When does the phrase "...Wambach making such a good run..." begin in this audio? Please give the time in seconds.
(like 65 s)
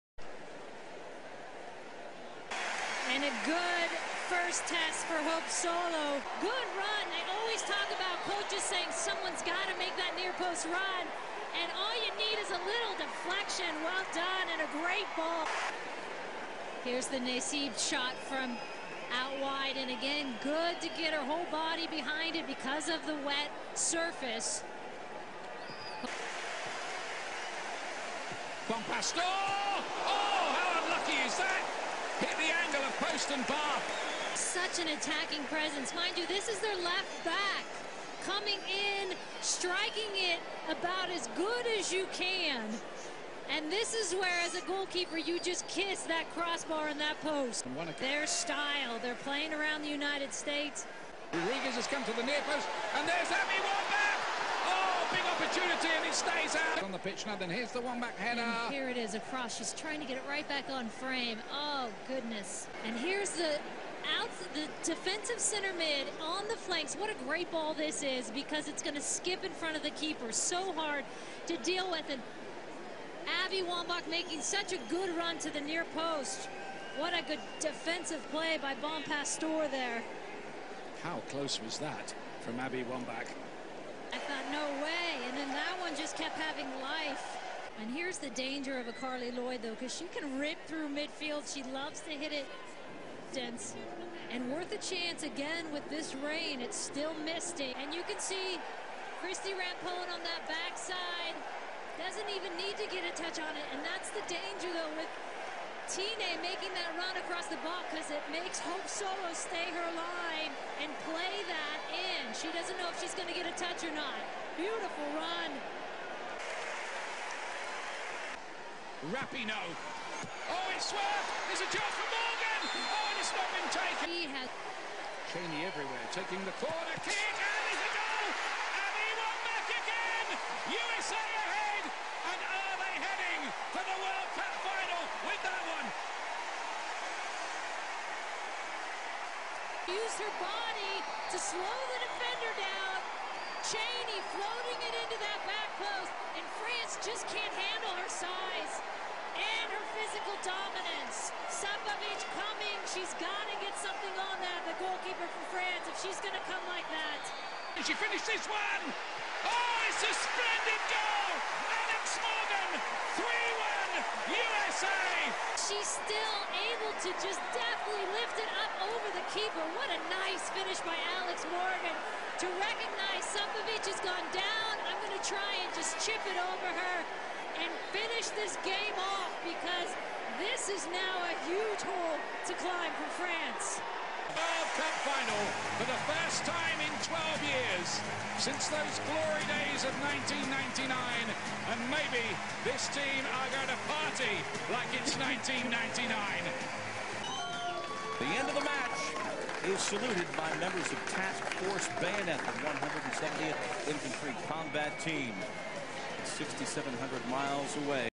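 73 s.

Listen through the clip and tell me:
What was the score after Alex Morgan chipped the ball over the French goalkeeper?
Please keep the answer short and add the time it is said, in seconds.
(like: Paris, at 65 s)
3-1, at 162 s.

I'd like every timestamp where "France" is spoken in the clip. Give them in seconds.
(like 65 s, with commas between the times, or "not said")
146 s, 155 s, 183 s.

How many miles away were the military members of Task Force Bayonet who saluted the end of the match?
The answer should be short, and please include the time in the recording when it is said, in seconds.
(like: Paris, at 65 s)
6,700, at 206 s.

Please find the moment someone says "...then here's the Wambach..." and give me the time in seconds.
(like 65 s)
57 s.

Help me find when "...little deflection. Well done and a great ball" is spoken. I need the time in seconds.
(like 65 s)
12 s.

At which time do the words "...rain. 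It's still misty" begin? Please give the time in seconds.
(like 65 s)
96 s.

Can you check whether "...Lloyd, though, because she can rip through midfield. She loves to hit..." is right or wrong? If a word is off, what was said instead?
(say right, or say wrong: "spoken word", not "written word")
right.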